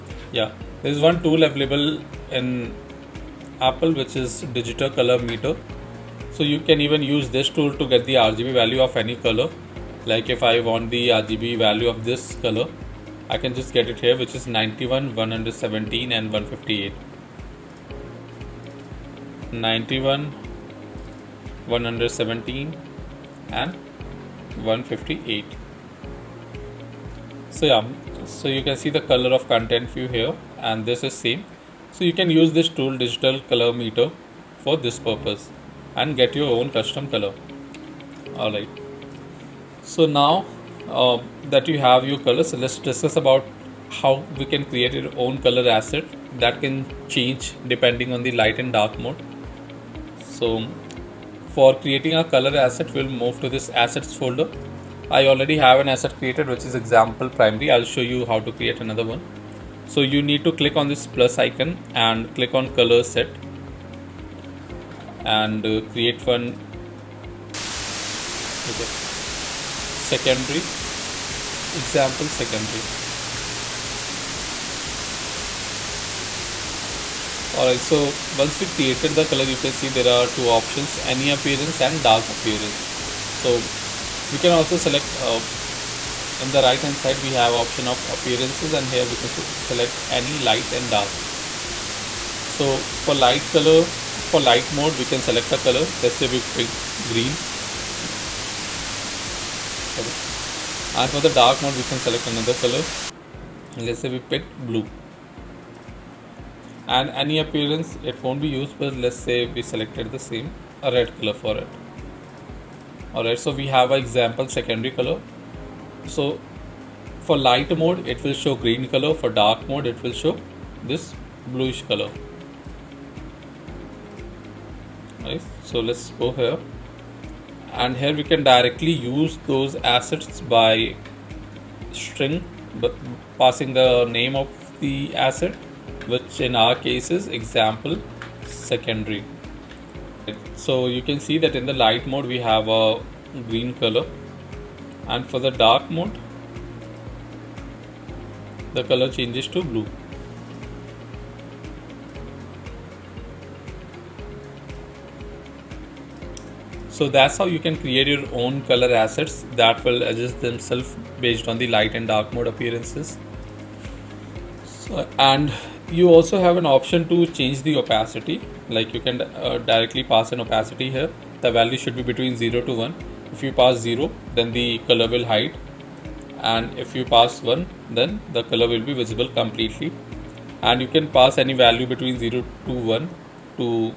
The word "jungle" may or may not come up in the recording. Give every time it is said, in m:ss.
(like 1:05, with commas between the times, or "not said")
not said.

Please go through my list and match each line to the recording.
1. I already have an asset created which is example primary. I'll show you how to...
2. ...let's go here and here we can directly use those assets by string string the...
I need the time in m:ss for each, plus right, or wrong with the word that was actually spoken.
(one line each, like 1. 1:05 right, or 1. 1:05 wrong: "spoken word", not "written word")
1. 0:55 right
2. 2:05 wrong: "passing", not "string".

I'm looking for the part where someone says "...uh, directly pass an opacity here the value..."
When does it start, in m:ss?
2:49.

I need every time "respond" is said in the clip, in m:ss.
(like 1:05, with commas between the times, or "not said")
not said.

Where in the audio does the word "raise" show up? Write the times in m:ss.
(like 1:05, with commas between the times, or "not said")
not said.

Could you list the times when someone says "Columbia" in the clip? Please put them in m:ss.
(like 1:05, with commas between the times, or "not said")
not said.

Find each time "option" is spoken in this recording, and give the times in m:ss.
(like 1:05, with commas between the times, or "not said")
1:20, 1:27, 2:46.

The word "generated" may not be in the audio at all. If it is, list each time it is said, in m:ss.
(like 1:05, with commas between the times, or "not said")
not said.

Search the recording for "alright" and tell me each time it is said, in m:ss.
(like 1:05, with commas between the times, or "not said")
0:38, 1:17, 1:53.